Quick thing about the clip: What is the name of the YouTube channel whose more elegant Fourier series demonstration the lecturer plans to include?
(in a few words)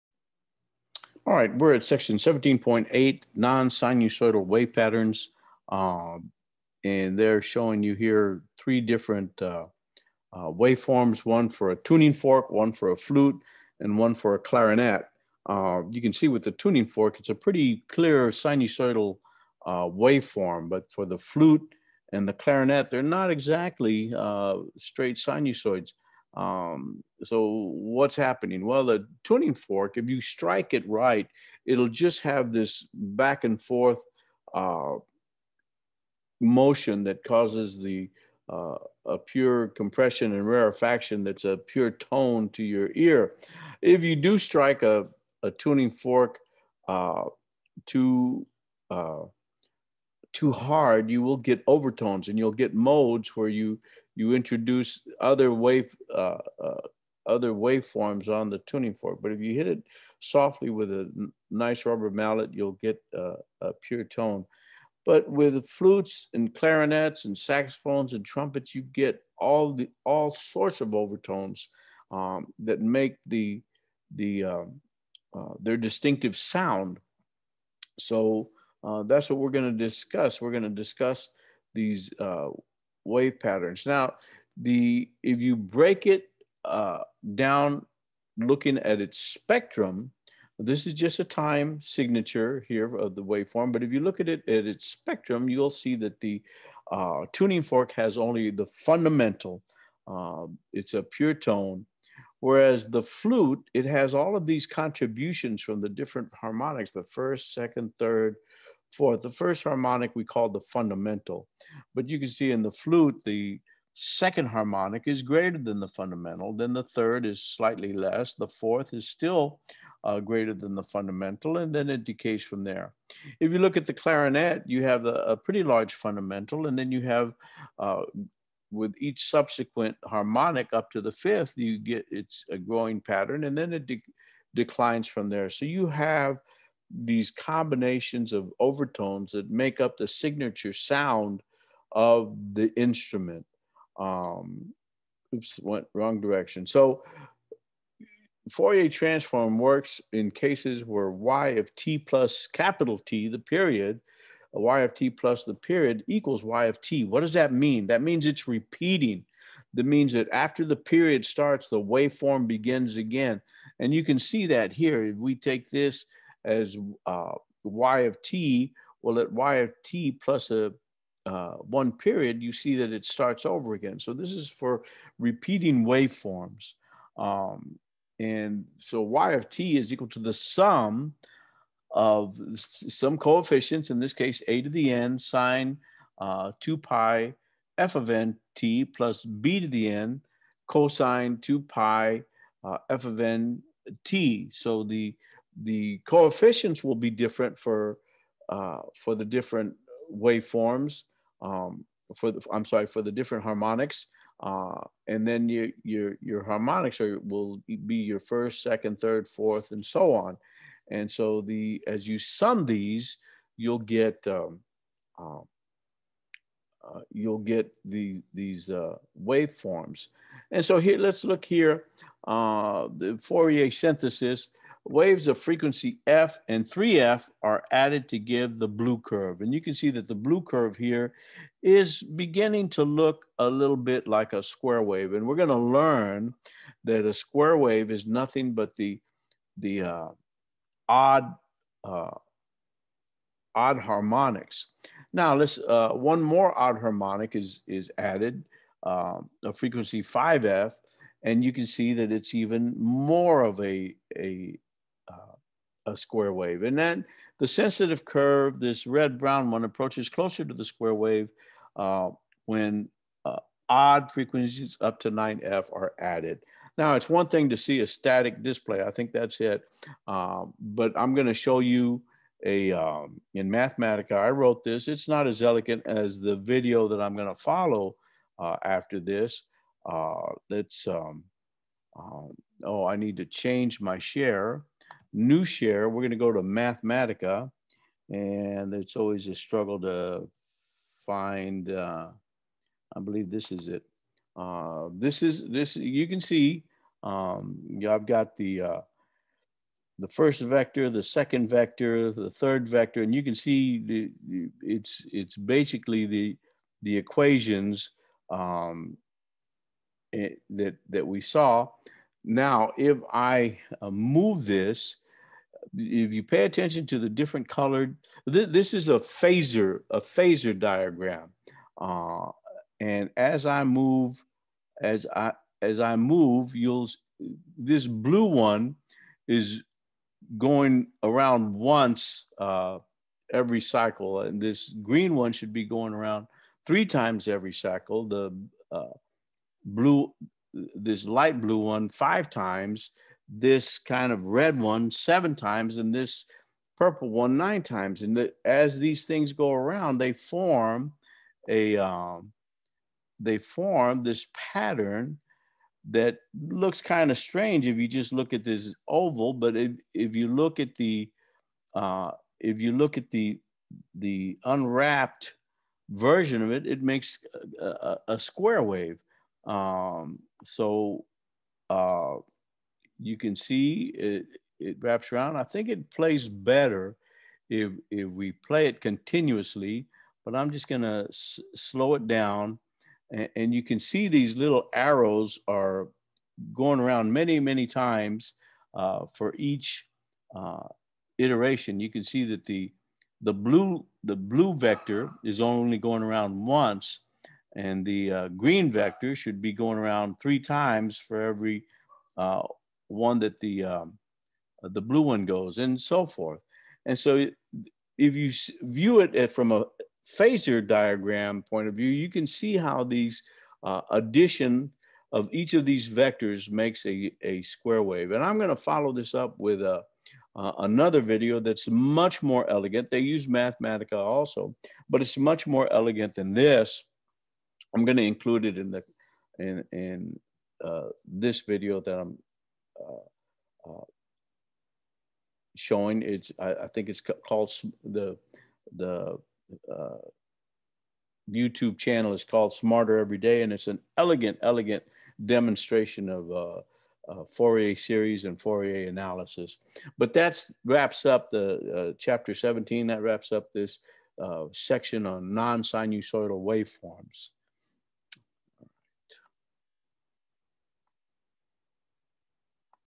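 Smarter Every Day.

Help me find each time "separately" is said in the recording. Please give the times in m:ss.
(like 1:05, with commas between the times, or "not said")
not said.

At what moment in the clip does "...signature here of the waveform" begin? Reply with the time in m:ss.
1:31.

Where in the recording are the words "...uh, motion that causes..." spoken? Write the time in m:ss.
0:34.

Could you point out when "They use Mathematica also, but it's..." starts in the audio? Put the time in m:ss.
7:02.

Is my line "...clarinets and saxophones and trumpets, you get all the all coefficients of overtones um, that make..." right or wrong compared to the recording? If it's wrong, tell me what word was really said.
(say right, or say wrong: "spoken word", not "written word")
wrong: "sorts", not "coefficients".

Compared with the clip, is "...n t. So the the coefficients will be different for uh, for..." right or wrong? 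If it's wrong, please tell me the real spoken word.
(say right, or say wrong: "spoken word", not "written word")
right.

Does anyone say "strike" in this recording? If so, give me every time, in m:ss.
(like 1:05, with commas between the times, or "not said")
0:30, 0:44.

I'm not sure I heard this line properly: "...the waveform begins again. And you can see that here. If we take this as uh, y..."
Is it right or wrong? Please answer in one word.
right.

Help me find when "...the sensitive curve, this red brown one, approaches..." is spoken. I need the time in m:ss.
4:17.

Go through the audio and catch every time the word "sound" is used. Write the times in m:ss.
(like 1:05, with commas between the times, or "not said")
1:16, 2:20.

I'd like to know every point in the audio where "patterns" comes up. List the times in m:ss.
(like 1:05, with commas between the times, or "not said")
0:04, 1:23, 2:13, 5:54.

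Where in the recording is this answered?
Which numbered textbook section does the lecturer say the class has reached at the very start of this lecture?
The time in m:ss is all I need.
0:02.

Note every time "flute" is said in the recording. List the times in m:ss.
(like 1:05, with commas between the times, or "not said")
0:12, 0:21, 1:05, 1:43, 1:52.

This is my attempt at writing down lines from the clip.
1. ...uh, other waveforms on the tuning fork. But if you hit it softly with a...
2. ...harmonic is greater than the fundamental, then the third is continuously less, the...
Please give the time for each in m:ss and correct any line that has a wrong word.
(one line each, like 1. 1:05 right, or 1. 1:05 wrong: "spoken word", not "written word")
1. 0:56 right
2. 1:54 wrong: "slightly", not "continuously".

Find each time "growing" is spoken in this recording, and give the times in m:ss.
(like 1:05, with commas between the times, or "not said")
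2:12.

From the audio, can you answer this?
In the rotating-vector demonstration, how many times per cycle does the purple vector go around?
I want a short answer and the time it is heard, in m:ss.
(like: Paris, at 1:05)
9, at 5:47.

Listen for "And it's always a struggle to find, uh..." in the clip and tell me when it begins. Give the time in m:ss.
4:48.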